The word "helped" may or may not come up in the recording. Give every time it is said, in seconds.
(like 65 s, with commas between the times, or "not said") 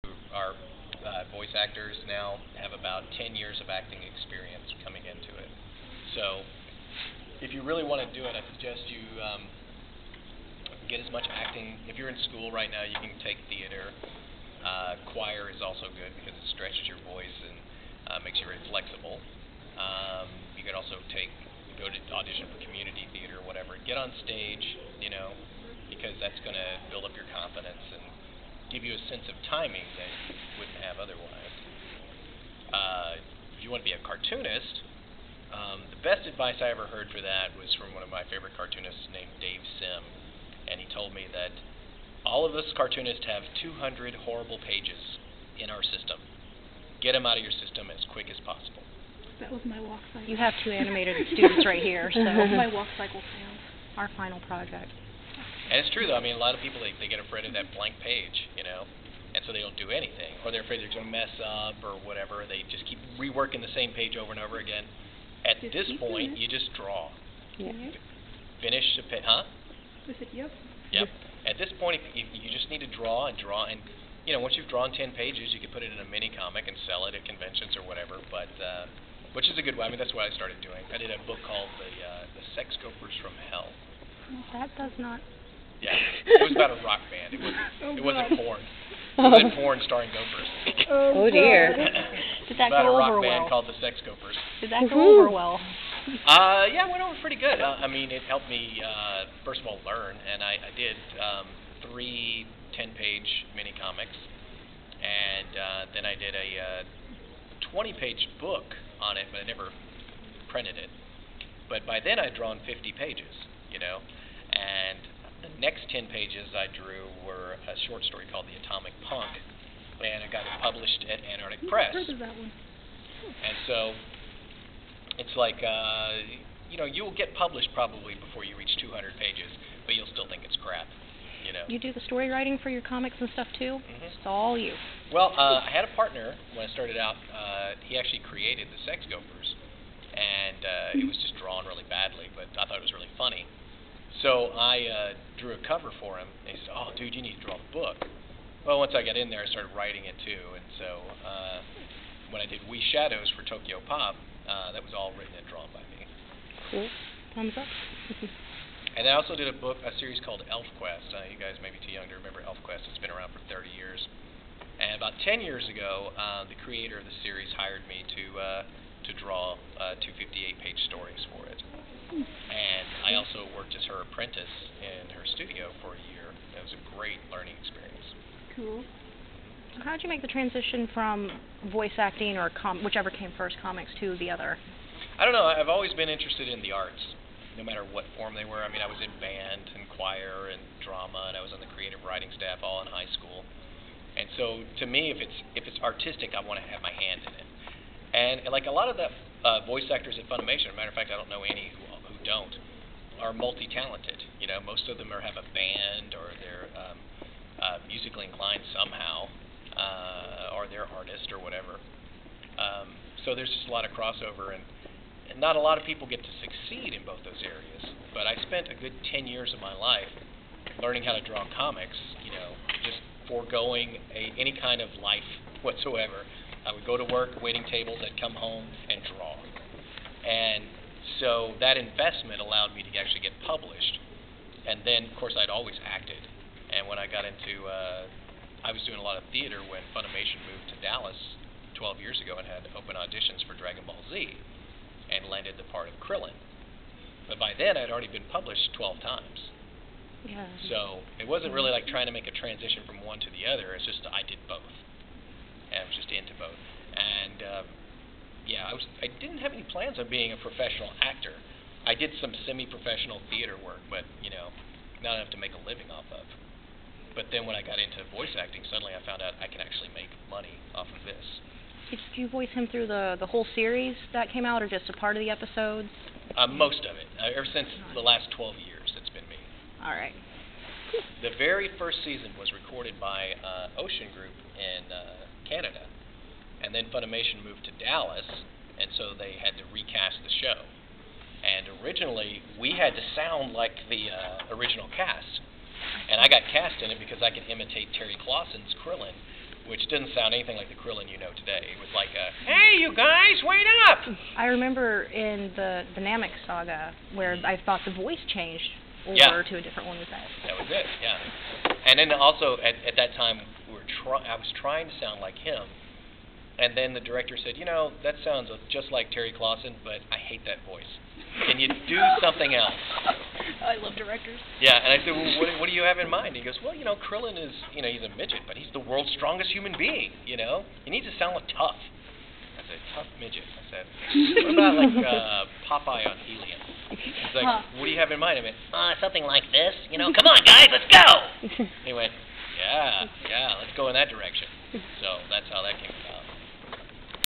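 98 s.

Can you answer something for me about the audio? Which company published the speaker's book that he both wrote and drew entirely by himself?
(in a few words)
Tokyo Pop.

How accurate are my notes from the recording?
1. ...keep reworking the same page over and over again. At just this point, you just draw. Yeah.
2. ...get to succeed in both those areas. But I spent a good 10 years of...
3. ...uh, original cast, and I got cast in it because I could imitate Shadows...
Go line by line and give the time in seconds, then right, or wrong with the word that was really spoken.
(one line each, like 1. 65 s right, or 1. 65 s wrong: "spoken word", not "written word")
1. 62 s right
2. 216 s right
3. 294 s wrong: "Terry", not "Shadows".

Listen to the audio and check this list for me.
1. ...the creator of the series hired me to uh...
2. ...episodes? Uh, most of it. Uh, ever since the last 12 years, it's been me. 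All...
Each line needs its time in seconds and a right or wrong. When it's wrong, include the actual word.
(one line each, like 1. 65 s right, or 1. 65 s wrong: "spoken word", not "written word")
1. 166 s right
2. 275 s right.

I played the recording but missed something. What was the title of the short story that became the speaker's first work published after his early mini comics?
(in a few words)
The Atomic Punk.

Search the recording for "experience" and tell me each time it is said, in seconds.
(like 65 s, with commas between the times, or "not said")
4 s, 177 s.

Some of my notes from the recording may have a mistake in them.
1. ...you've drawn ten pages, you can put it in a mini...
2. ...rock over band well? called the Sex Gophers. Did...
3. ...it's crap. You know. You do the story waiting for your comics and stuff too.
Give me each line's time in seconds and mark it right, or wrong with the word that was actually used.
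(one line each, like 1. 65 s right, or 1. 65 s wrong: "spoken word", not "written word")
1. 74 s right
2. 92 s right
3. 130 s wrong: "writing", not "waiting".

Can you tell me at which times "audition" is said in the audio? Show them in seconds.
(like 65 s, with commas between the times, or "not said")
22 s, 242 s.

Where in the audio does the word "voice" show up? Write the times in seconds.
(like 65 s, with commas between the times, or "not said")
1 s, 17 s, 181 s, 199 s, 268 s, 272 s, 307 s, 320 s.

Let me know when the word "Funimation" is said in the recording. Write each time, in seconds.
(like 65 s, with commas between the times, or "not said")
200 s, 239 s, 286 s.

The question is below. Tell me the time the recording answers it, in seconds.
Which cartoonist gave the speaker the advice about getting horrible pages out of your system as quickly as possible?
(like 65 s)
39 s.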